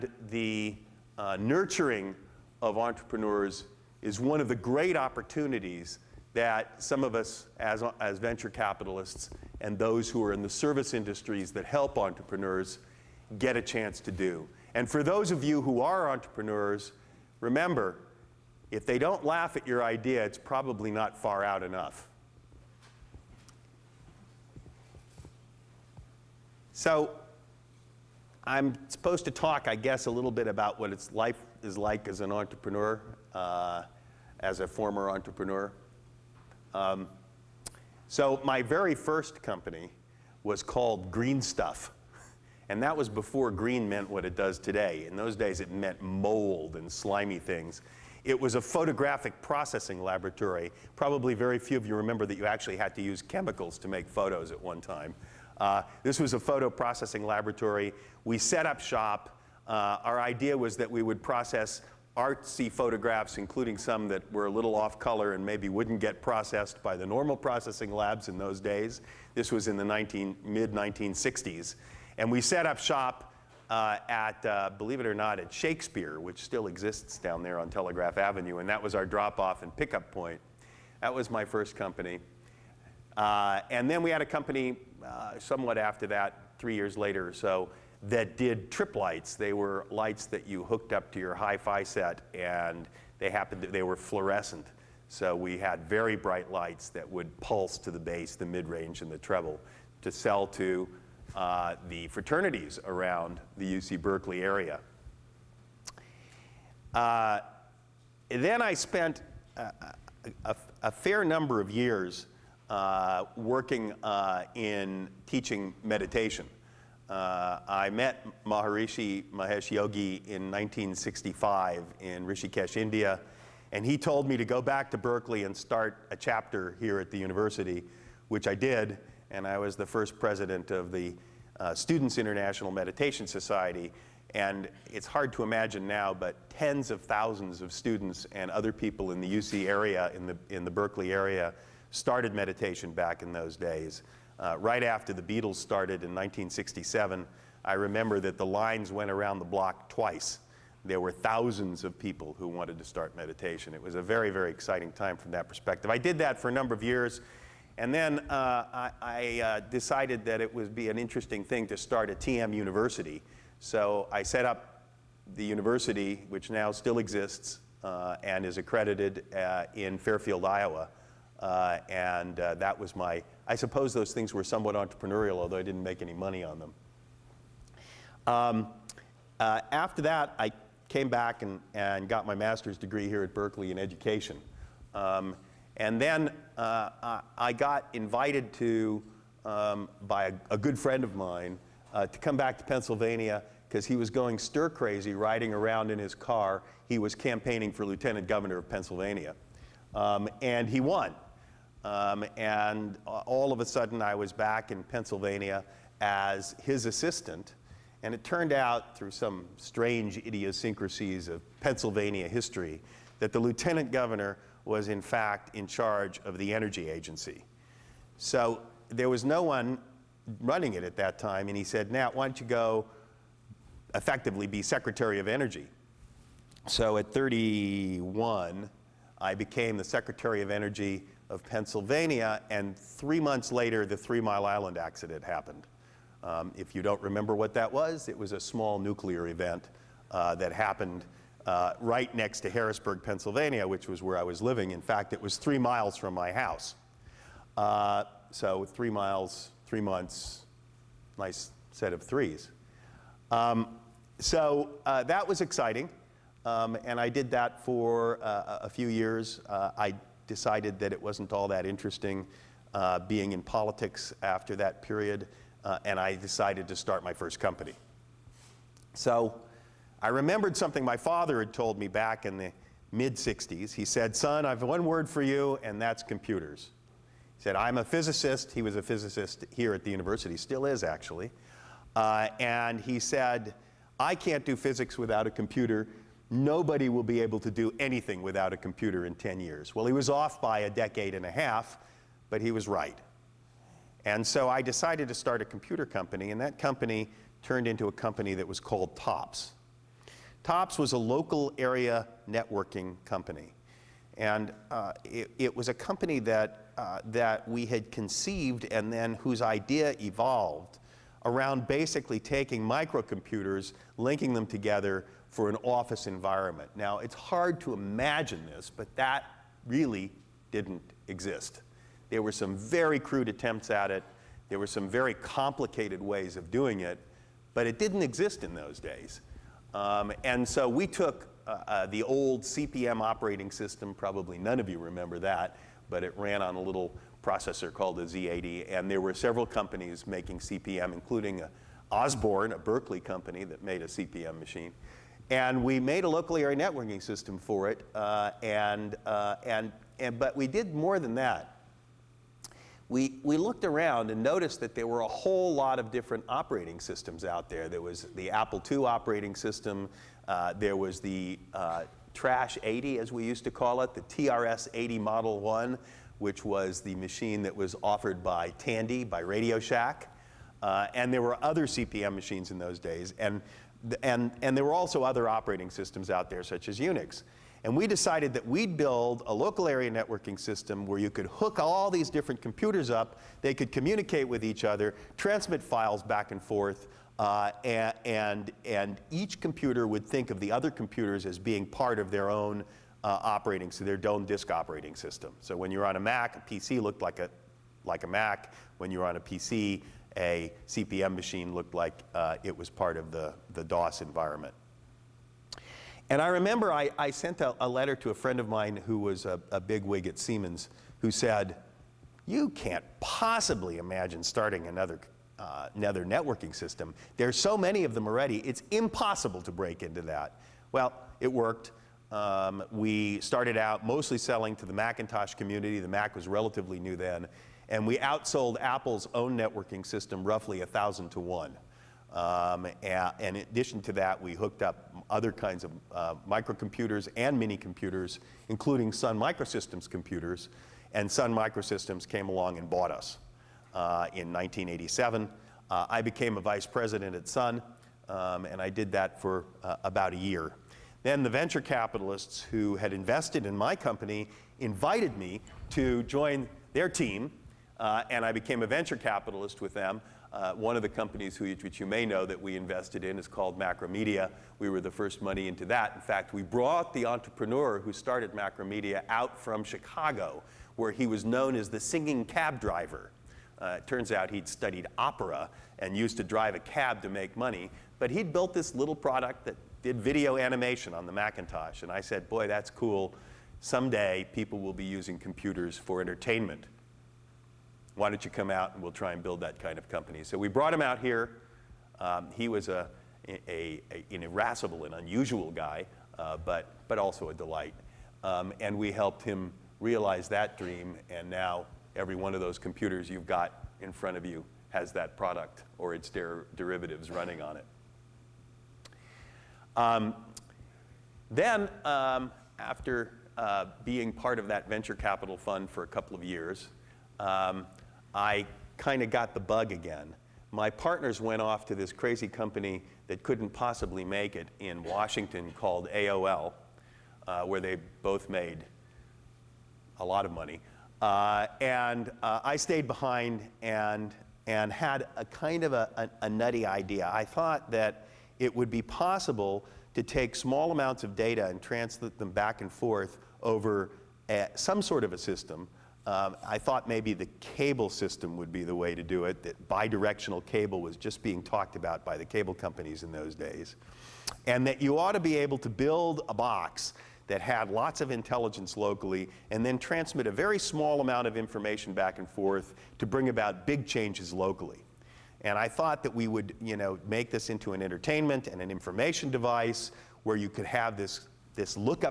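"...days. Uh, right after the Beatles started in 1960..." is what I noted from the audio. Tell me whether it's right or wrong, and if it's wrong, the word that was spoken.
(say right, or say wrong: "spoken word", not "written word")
wrong: "1967", not "1960".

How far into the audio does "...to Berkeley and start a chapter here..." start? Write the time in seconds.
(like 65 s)
124 s.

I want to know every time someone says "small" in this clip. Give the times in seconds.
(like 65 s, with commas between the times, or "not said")
238 s, 540 s, 560 s.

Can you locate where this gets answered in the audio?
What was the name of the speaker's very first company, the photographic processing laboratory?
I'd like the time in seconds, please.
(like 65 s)
41 s.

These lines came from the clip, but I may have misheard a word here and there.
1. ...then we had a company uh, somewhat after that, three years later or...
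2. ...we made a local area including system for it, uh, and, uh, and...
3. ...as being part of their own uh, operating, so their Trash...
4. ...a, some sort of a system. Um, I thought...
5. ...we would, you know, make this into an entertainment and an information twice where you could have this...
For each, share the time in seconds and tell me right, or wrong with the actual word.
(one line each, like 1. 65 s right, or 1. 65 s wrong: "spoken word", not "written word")
1. 83 s right
2. 345 s wrong: "networking", not "including"
3. 391 s wrong: "Dome", not "Trash"
4. 544 s right
5. 566 s wrong: "device", not "twice".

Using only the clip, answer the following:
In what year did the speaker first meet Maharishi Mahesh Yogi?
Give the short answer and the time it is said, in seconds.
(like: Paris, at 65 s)
1965, at 120 s.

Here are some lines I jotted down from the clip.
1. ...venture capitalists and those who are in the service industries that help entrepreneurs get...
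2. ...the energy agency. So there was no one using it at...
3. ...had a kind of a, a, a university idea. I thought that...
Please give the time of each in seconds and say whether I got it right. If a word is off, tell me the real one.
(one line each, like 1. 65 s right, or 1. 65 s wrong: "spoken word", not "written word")
1. 8 s right
2. 216 s wrong: "running", not "using"
3. 534 s wrong: "nutty", not "university".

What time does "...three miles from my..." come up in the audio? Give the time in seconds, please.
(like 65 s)
245 s.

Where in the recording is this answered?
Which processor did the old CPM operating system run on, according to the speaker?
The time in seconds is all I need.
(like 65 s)
338 s.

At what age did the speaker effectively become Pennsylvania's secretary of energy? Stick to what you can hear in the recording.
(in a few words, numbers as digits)
31.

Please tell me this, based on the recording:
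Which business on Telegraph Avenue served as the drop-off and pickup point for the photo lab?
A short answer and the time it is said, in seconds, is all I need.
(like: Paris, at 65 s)
Shakespeare, at 75 s.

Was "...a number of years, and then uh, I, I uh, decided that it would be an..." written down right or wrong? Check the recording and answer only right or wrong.
right.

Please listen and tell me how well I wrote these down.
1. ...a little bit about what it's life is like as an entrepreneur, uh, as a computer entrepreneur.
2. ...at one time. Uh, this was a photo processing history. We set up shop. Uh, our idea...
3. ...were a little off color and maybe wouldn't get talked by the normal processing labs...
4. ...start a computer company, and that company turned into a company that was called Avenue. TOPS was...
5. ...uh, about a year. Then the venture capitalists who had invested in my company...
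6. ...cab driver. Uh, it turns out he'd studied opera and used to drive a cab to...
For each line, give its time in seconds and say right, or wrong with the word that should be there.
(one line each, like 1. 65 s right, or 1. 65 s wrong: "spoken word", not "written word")
1. 30 s wrong: "former", not "computer"
2. 54 s wrong: "laboratory", not "history"
3. 64 s wrong: "processed", not "talked"
4. 295 s wrong: "TOPS", not "Avenue"
5. 449 s right
6. 472 s right.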